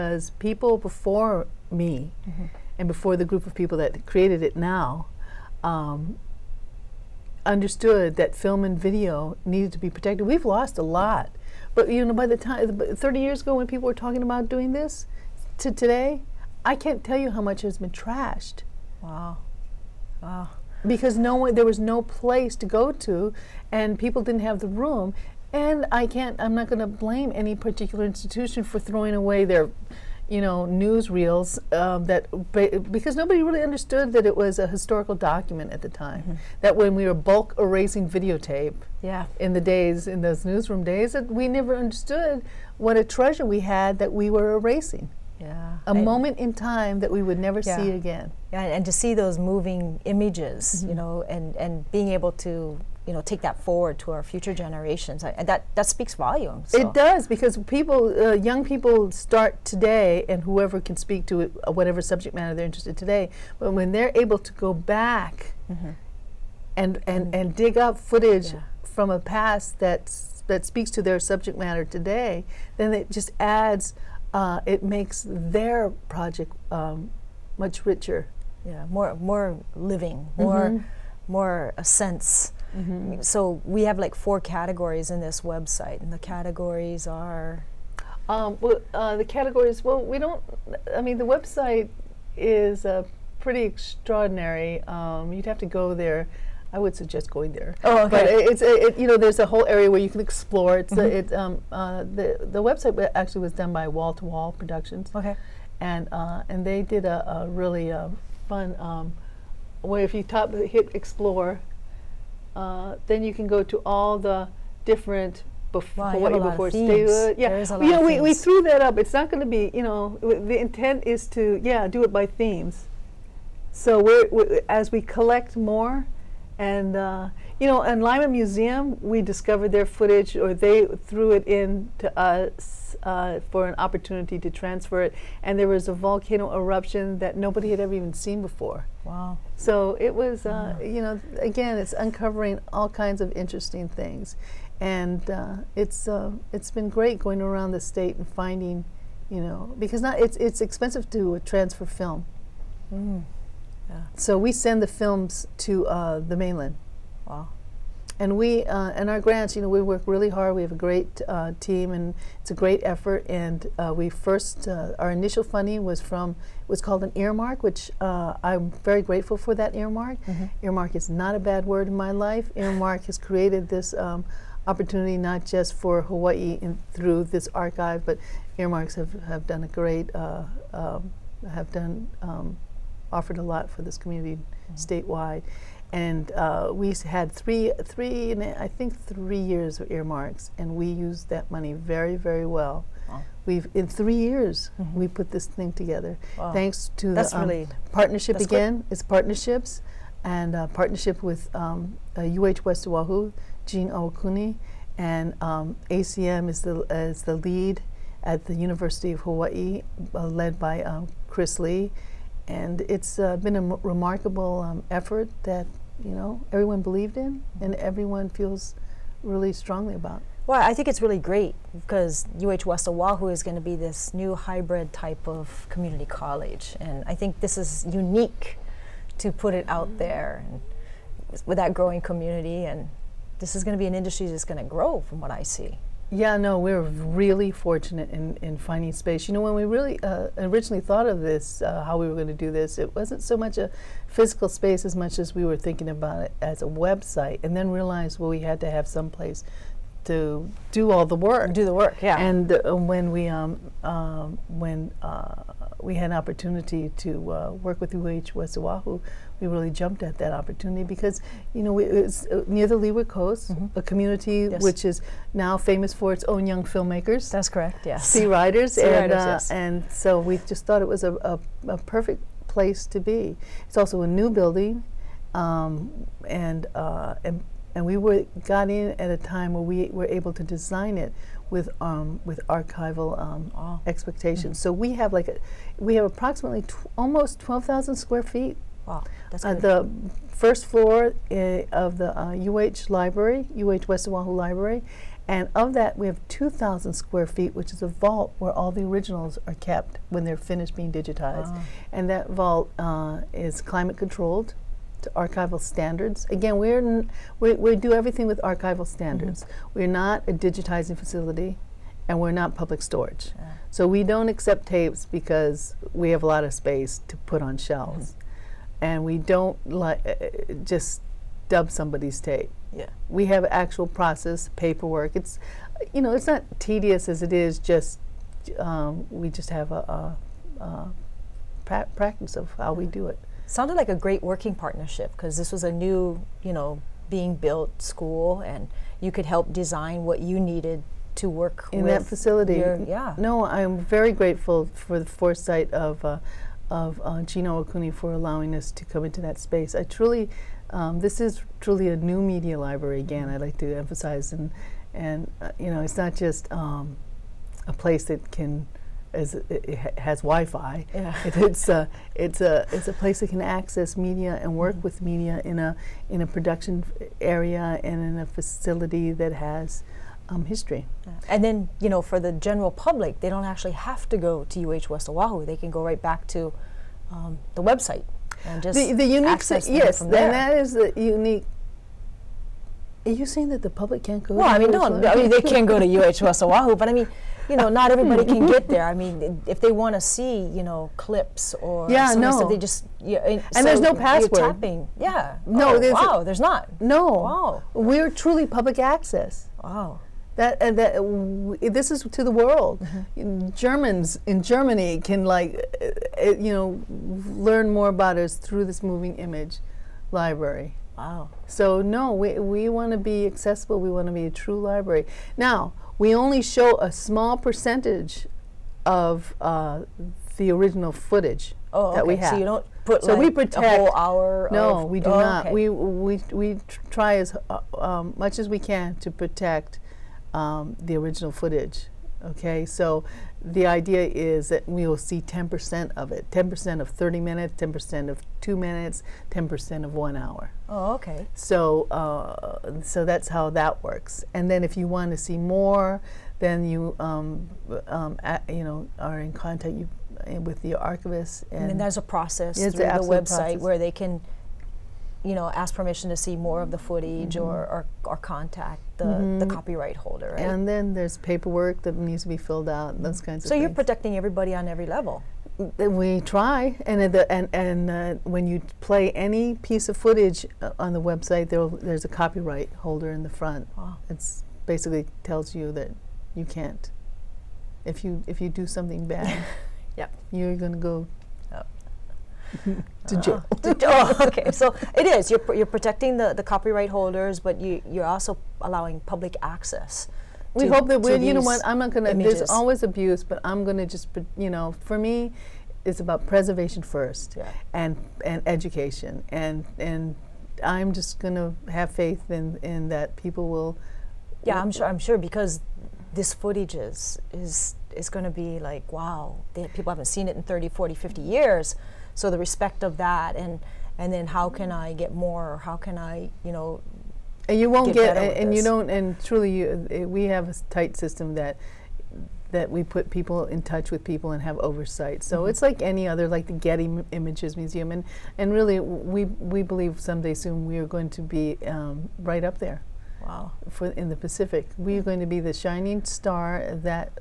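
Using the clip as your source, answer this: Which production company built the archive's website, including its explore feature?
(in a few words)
Wall to Wall Productions.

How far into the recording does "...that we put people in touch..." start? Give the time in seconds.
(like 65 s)
522 s.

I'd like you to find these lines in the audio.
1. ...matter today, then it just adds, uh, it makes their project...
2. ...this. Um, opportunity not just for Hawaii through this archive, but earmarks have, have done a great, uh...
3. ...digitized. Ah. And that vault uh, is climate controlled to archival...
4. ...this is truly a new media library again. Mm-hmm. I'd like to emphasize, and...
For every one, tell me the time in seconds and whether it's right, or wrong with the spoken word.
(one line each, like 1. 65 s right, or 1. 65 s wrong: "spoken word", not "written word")
1. 71 s right
2. 173 s right
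3. 300 s right
4. 351 s right.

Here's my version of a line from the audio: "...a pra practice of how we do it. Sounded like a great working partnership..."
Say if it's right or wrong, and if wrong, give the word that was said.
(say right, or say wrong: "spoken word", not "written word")
right.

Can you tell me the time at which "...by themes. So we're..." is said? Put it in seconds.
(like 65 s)
122 s.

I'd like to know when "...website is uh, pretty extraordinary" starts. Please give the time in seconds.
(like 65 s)
91 s.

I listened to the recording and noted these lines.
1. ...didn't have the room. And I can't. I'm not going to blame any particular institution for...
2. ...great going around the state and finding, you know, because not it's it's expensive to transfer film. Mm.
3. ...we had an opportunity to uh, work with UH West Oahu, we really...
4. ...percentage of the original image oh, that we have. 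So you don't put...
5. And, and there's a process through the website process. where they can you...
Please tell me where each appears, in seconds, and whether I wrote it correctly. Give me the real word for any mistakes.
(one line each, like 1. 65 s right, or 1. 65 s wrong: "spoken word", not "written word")
1. 24 s right
2. 146 s right
3. 255 s right
4. 417 s wrong: "footage", not "image"
5. 451 s right.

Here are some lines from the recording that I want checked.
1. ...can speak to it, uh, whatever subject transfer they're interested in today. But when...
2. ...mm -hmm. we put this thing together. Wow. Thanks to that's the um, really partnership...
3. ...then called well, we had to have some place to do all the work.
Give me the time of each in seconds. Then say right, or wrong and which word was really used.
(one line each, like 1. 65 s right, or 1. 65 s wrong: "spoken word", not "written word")
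1. 60 s wrong: "matter", not "transfer"
2. 194 s right
3. 247 s wrong: "realized", not "called".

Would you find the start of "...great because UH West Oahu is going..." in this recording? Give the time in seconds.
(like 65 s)
221 s.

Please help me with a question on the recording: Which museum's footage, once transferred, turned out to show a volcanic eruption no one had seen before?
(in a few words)
Lyman Museum.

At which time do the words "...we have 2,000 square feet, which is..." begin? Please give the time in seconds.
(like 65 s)
295 s.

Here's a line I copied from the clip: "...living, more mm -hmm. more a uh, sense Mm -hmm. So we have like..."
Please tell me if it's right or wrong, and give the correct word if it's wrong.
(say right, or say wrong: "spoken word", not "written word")
right.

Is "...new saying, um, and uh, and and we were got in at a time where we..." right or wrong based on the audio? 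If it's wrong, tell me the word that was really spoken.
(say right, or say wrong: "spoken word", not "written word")
wrong: "building", not "saying".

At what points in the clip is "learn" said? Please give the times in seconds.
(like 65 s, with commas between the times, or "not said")
407 s.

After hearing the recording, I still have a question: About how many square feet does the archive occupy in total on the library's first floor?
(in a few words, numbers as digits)
12,000 square feet.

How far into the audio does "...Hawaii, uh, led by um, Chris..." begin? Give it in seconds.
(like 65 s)
209 s.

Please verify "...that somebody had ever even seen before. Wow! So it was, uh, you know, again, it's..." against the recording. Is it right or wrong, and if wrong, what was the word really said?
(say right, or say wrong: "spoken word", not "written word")
wrong: "nobody", not "somebody".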